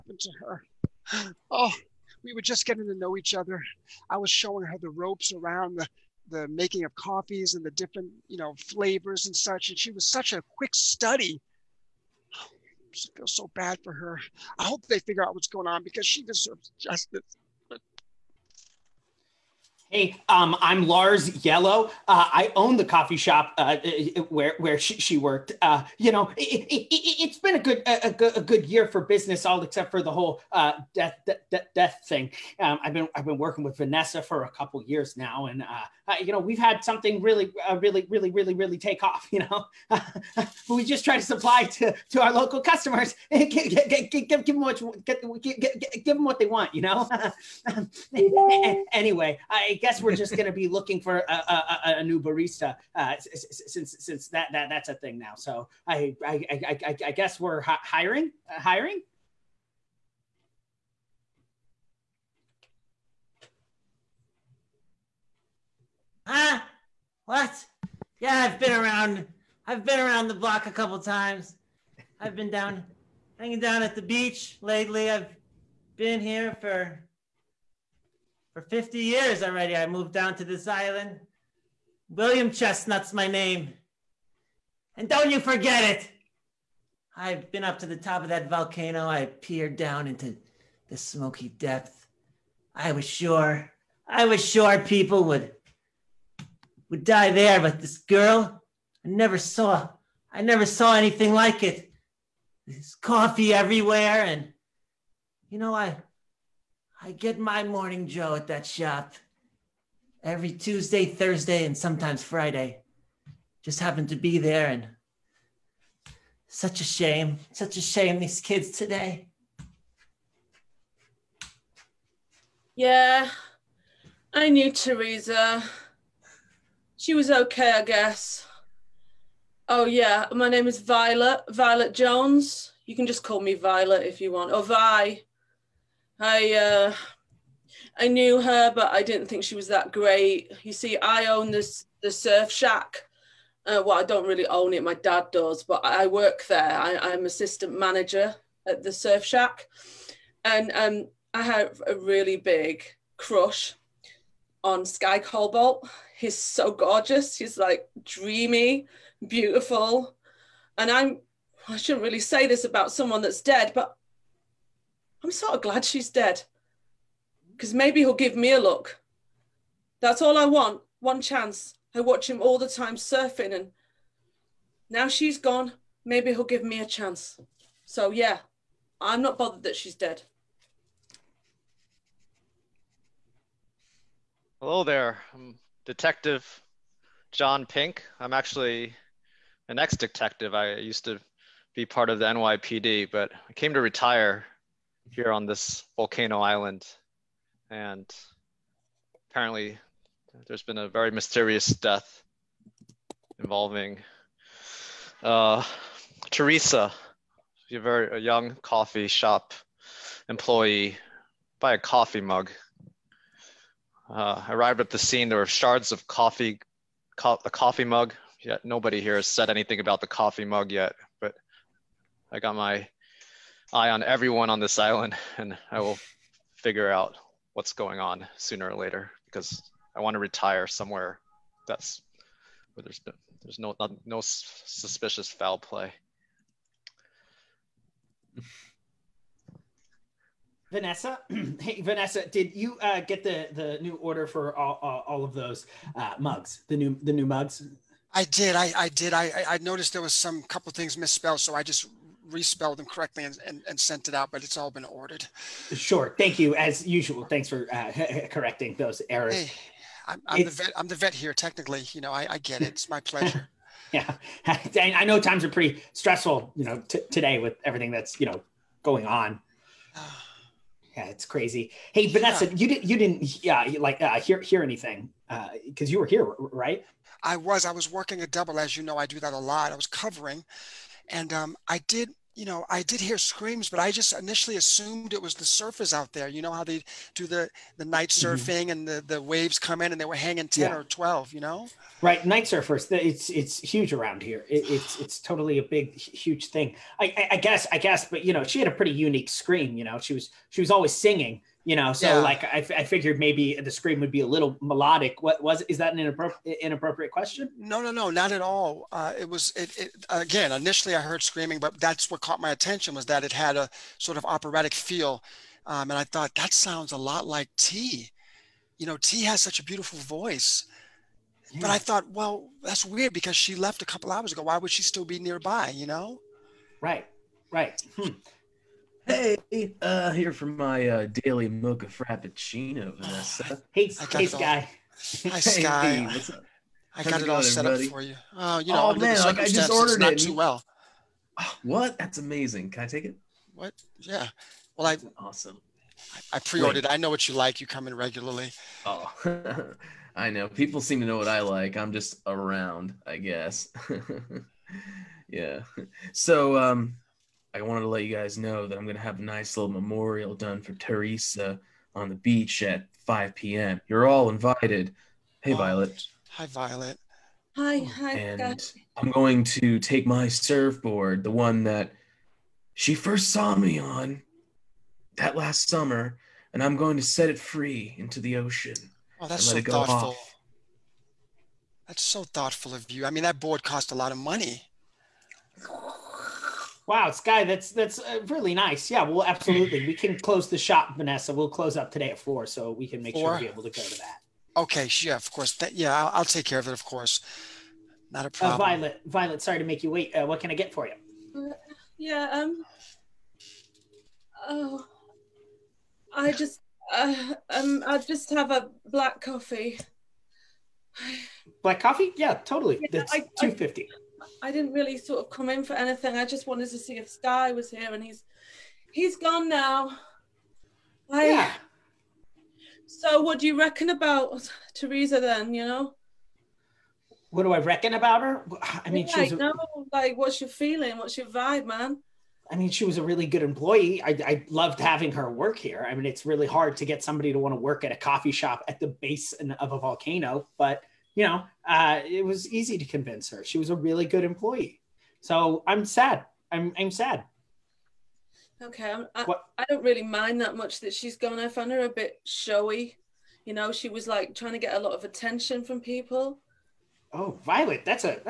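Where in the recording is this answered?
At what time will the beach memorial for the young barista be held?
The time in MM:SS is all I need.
06:03.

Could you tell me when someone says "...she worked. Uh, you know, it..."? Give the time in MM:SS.
00:24.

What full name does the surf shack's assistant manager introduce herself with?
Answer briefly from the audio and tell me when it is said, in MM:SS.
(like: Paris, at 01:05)
Violet Jones, at 02:11.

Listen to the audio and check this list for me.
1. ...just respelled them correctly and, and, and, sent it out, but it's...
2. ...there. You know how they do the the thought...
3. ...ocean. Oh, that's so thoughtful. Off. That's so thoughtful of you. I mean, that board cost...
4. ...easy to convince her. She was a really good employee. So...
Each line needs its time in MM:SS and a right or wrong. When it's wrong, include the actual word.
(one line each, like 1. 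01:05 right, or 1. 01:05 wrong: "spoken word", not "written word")
1. 04:11 right
2. 04:46 wrong: "night", not "thought"
3. 06:18 right
4. 07:22 right.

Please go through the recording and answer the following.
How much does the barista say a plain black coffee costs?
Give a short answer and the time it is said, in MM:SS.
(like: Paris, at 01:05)
2.50, at 06:53.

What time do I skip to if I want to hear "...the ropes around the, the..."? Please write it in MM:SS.
00:04.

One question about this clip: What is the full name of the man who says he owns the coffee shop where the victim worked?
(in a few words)
Lars Yellow.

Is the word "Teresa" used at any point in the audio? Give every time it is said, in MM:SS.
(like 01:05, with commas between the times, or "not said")
02:04, 03:26, 06:00, 07:04.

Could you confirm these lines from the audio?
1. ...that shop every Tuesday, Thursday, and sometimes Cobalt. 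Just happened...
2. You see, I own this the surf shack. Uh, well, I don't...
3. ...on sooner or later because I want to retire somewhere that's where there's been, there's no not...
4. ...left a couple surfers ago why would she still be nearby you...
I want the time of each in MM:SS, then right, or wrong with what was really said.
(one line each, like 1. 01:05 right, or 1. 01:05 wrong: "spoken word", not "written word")
1. 01:48 wrong: "Friday", not "Cobalt"
2. 02:20 right
3. 03:47 right
4. 05:23 wrong: "hours", not "surfers".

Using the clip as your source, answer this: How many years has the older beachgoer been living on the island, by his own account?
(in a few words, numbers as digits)
50.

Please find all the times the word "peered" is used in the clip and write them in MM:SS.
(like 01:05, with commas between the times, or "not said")
01:29.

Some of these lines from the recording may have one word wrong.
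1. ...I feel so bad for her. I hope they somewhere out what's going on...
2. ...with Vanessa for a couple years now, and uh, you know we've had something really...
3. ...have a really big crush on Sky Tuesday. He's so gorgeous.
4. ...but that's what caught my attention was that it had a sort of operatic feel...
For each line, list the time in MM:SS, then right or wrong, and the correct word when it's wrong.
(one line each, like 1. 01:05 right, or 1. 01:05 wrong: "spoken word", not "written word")
1. 00:12 wrong: "figure", not "somewhere"
2. 00:33 right
3. 02:31 wrong: "Cobalt", not "Tuesday"
4. 05:11 right.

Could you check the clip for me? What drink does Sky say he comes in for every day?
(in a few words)
mocha frappuccino.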